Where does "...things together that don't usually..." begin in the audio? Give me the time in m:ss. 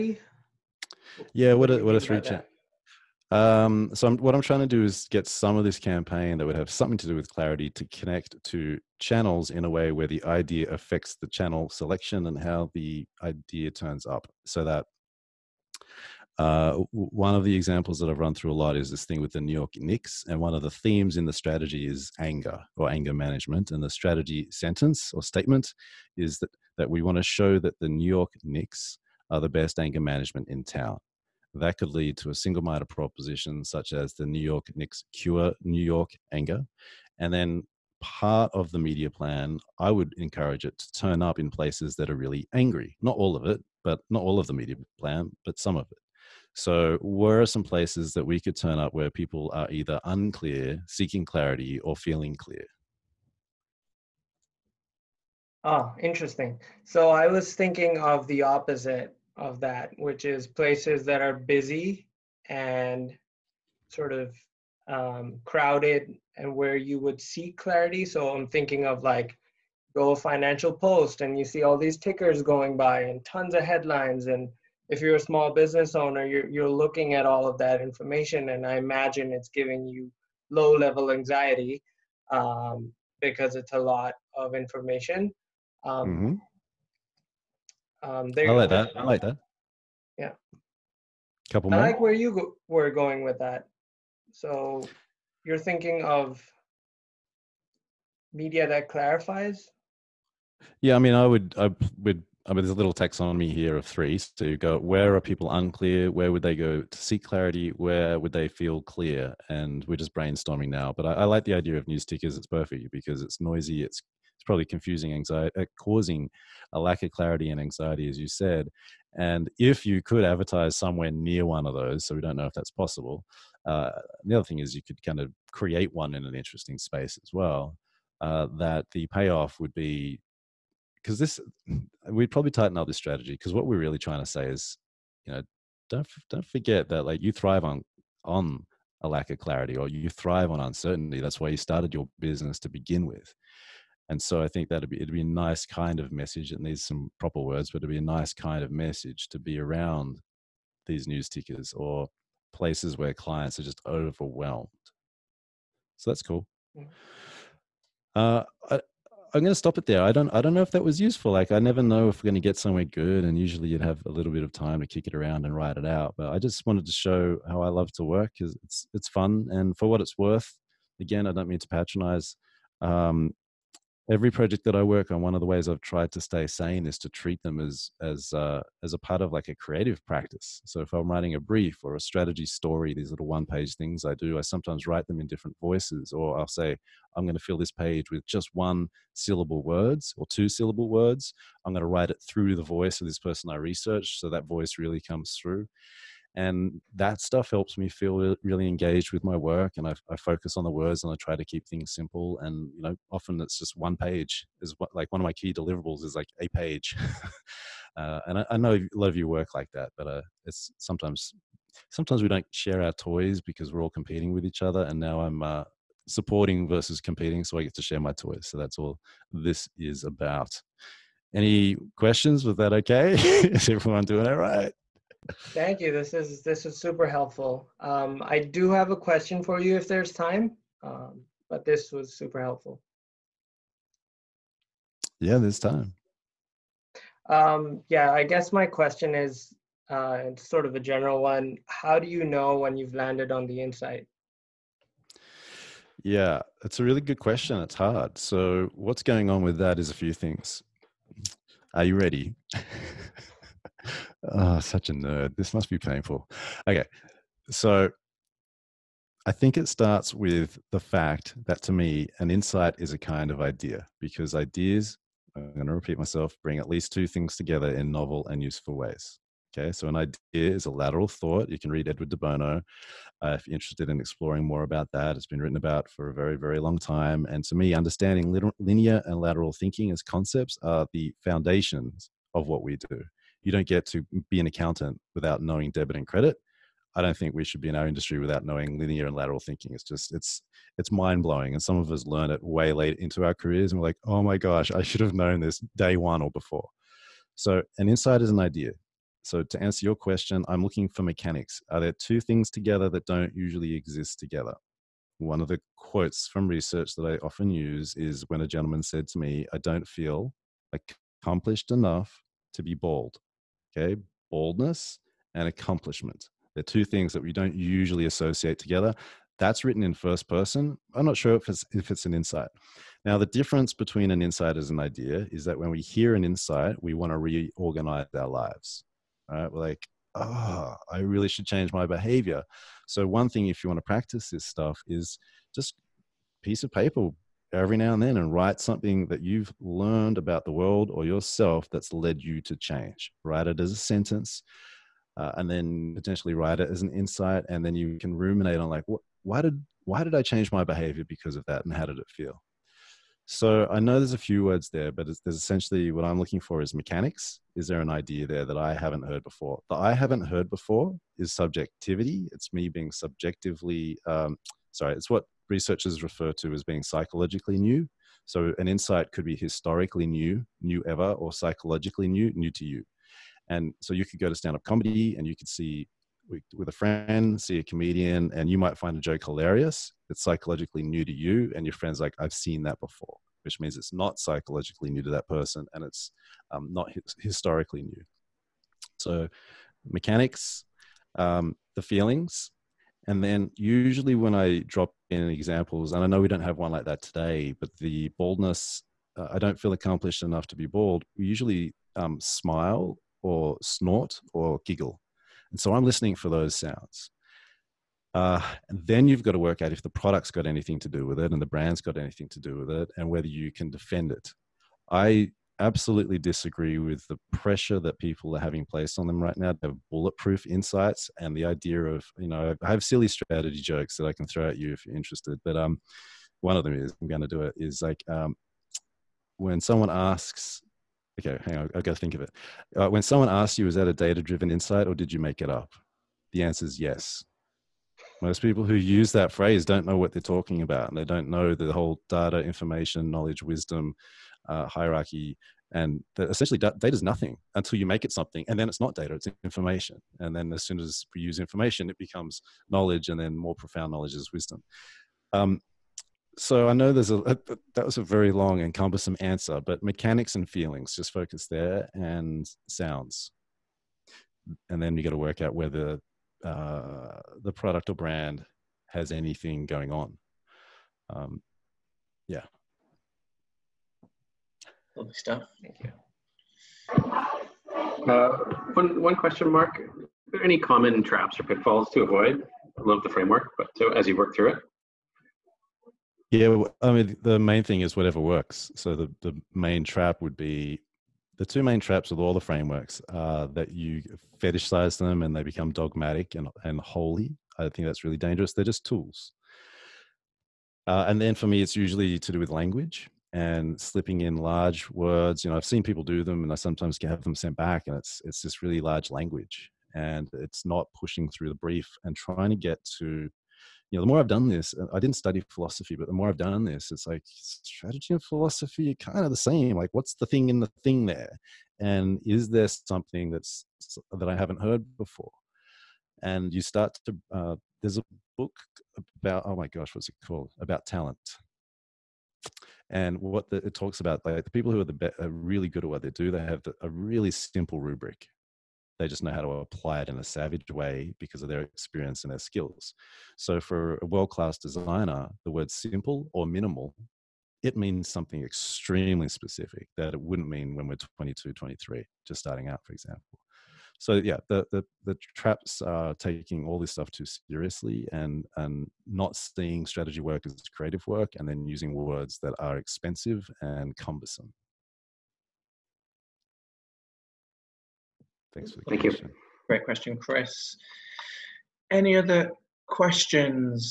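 5:02.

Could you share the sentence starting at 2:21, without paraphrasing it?
That's why you started your business to begin with.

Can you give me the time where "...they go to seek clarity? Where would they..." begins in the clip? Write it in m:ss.
1:46.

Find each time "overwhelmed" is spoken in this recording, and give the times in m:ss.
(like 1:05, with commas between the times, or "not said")
2:33.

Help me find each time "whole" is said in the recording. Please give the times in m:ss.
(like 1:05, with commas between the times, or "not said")
7:21.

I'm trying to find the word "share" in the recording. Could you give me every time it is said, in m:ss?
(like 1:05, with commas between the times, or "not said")
3:32, 3:37.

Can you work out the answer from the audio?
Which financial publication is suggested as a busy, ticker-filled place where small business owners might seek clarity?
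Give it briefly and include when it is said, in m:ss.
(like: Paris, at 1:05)
Financial Post, at 1:10.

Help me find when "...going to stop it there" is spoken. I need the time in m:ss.
2:39.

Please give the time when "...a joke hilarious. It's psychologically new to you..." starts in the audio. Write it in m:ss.
6:18.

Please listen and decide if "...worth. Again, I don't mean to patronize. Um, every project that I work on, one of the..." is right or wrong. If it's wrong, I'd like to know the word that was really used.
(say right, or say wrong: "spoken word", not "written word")
right.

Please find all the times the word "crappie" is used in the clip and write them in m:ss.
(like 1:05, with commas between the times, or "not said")
not said.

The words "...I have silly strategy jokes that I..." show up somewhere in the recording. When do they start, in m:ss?
7:02.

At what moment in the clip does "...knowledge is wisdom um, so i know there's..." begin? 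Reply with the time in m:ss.
7:33.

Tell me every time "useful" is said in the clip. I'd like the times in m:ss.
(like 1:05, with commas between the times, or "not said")
2:40, 4:28.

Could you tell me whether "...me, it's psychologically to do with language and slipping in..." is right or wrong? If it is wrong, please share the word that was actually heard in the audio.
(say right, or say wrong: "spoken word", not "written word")
wrong: "usually", not "psychologically".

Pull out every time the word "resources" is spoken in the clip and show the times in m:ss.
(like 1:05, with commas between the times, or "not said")
not said.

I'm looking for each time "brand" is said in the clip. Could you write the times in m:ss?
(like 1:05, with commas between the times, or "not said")
6:51, 7:47.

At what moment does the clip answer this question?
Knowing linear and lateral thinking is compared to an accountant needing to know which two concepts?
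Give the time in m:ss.
4:45.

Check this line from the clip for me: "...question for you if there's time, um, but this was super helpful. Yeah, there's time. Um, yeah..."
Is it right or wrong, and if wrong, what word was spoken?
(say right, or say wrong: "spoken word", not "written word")
right.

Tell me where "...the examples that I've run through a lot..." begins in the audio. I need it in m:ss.
0:17.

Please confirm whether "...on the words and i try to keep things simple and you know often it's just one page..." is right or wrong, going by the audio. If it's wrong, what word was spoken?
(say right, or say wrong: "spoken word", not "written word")
right.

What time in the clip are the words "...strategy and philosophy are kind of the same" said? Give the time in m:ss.
8:37.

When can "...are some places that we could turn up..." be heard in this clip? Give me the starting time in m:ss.
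0:47.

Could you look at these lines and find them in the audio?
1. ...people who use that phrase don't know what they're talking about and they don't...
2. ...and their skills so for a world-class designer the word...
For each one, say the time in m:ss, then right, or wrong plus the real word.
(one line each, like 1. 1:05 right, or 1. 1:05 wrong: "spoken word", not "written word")
1. 7:18 right
2. 9:02 right.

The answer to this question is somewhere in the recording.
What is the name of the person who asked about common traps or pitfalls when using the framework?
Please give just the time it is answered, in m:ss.
9:30.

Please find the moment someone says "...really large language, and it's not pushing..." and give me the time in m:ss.
8:28.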